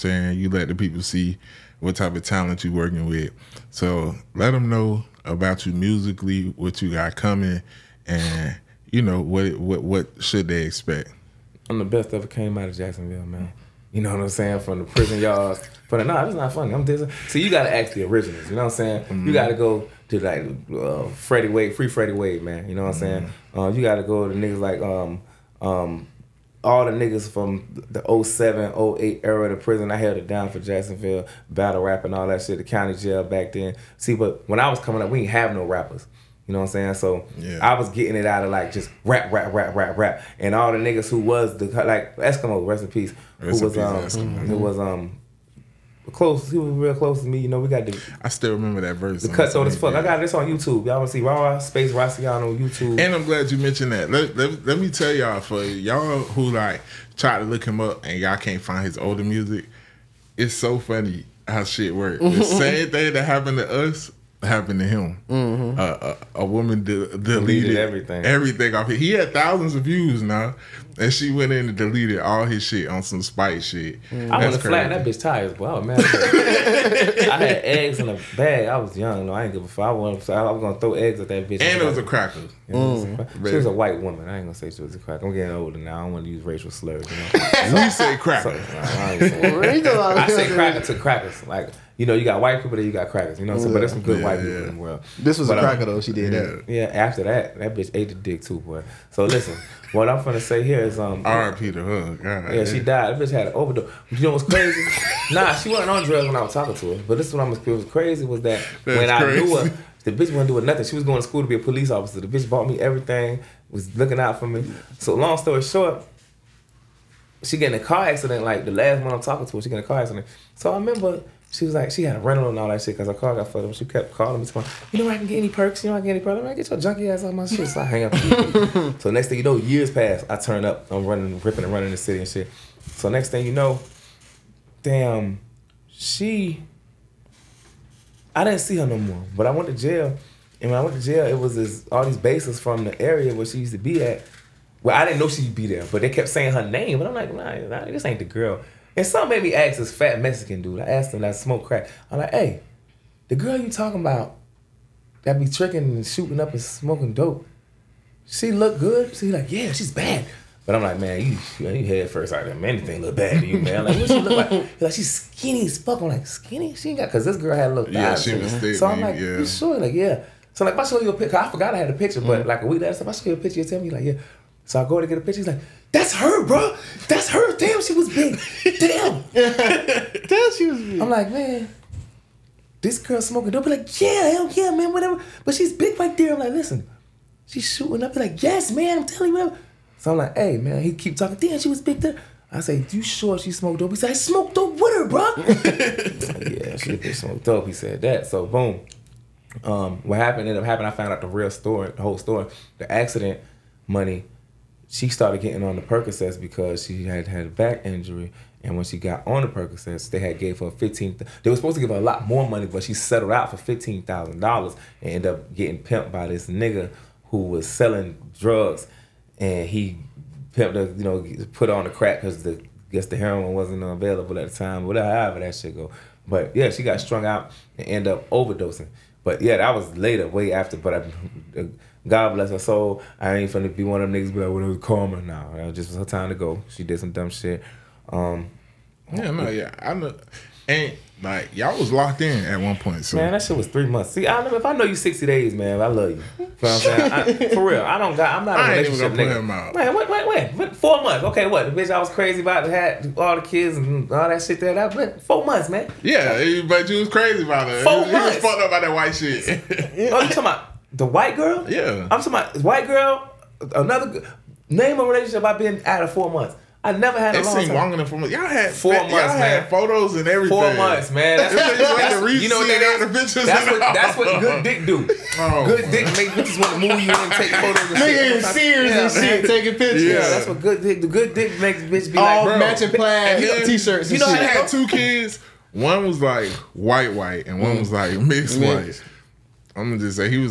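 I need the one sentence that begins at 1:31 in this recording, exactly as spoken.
Like you know, you got white people there, you got crackers.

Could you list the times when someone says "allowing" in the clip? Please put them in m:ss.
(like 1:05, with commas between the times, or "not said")
not said.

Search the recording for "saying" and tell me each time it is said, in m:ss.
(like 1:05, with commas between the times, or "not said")
0:14, 0:18, 0:23, 0:36, 2:26, 4:06.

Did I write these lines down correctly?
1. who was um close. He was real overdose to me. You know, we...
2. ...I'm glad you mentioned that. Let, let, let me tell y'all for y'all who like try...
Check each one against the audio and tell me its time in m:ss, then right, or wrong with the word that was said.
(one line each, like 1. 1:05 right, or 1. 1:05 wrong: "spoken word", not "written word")
1. 0:44 wrong: "close", not "overdose"
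2. 0:53 right.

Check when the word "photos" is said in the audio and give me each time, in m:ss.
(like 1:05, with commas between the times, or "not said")
4:29, 4:37.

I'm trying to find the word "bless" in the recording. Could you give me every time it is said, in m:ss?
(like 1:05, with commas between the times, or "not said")
3:52.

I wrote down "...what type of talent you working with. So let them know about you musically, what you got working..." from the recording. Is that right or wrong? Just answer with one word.
wrong.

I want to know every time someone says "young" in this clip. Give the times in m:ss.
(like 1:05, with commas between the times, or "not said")
1:18.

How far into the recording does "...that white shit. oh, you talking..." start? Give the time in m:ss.
4:18.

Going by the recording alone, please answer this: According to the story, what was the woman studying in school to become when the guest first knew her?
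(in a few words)
Police officer.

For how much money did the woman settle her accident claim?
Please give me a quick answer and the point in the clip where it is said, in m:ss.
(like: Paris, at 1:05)
$15,000, at 3:33.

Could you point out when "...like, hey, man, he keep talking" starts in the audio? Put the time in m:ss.
3:10.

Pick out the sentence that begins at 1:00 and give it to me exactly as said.
It's so funny how shit works.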